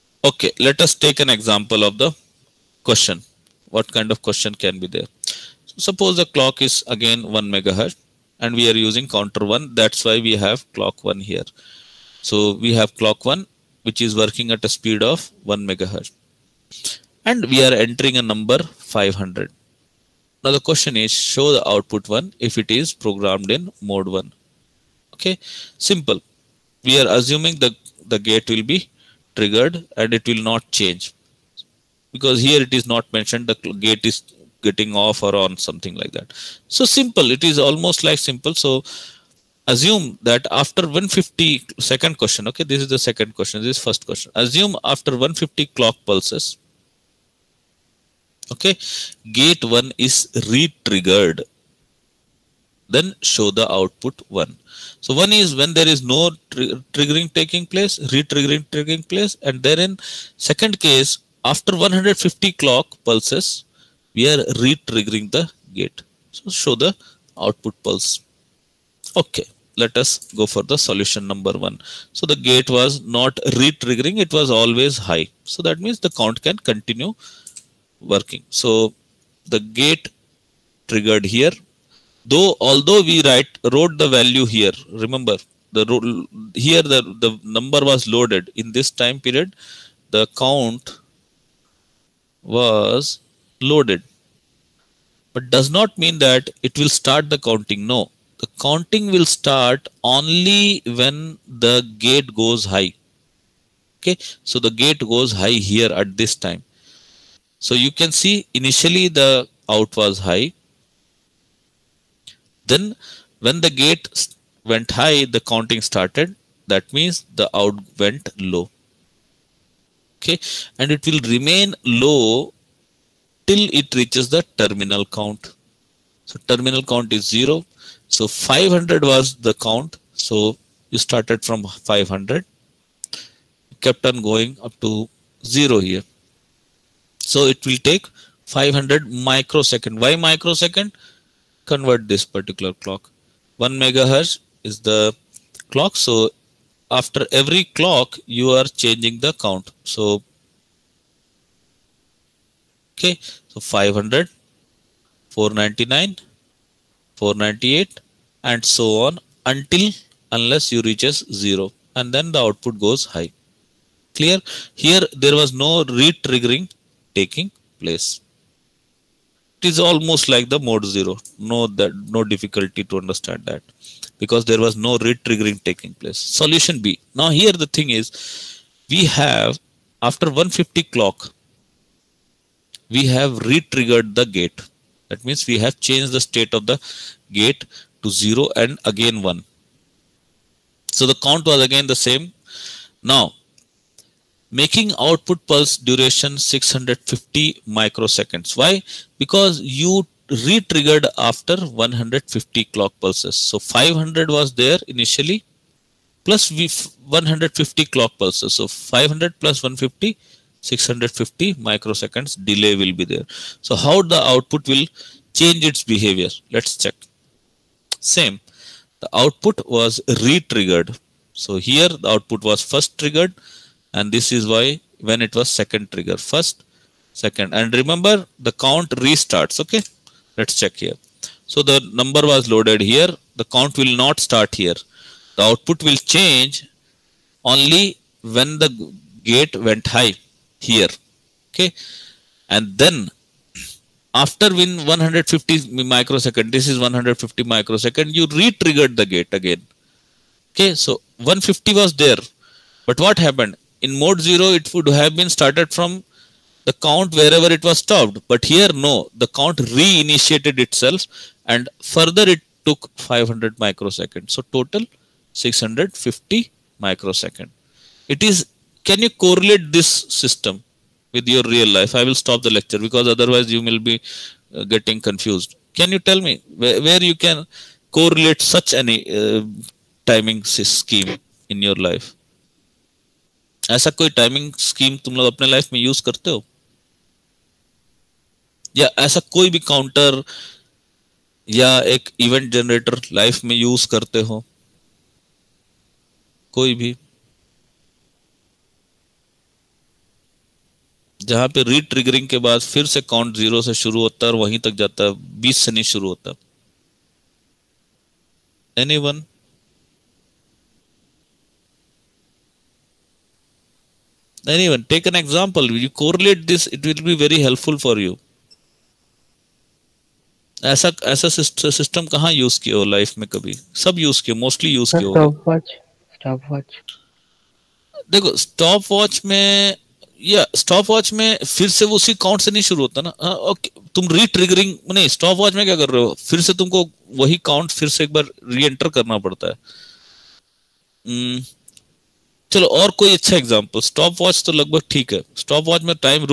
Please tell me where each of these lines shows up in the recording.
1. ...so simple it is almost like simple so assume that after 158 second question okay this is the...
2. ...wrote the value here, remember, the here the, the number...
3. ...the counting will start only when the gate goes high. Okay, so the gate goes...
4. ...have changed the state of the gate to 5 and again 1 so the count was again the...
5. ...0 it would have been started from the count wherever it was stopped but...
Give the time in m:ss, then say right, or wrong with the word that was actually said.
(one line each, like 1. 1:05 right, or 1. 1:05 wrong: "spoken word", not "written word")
1. 0:36 wrong: "150", not "158"
2. 1:23 right
3. 1:38 right
4. 3:05 wrong: "0", not "5"
5. 4:14 right.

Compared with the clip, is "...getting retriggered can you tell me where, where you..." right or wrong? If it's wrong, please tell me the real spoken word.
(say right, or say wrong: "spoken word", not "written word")
wrong: "confused", not "retriggered".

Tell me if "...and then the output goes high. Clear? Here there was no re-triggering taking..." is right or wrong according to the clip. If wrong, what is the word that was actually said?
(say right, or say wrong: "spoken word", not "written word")
right.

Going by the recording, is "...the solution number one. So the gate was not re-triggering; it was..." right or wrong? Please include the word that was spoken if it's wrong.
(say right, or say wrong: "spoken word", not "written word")
right.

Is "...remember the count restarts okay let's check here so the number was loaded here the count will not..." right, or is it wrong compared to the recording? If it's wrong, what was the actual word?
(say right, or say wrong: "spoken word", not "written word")
right.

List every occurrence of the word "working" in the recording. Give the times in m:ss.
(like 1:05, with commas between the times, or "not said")
0:14, 1:17.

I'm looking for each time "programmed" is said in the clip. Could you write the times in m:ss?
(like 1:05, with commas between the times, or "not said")
0:23.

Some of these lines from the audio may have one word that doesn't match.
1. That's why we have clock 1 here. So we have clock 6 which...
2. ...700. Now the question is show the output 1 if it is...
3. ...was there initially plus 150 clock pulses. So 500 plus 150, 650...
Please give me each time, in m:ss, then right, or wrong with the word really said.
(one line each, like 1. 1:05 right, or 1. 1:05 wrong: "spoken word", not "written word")
1. 0:09 wrong: "1", not "6"
2. 0:18 wrong: "500", not "700"
3. 3:24 right.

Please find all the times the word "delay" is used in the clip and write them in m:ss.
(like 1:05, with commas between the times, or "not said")
3:32.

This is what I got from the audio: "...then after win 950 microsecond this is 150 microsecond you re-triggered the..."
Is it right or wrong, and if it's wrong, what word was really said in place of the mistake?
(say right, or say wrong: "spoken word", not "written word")
wrong: "150", not "950".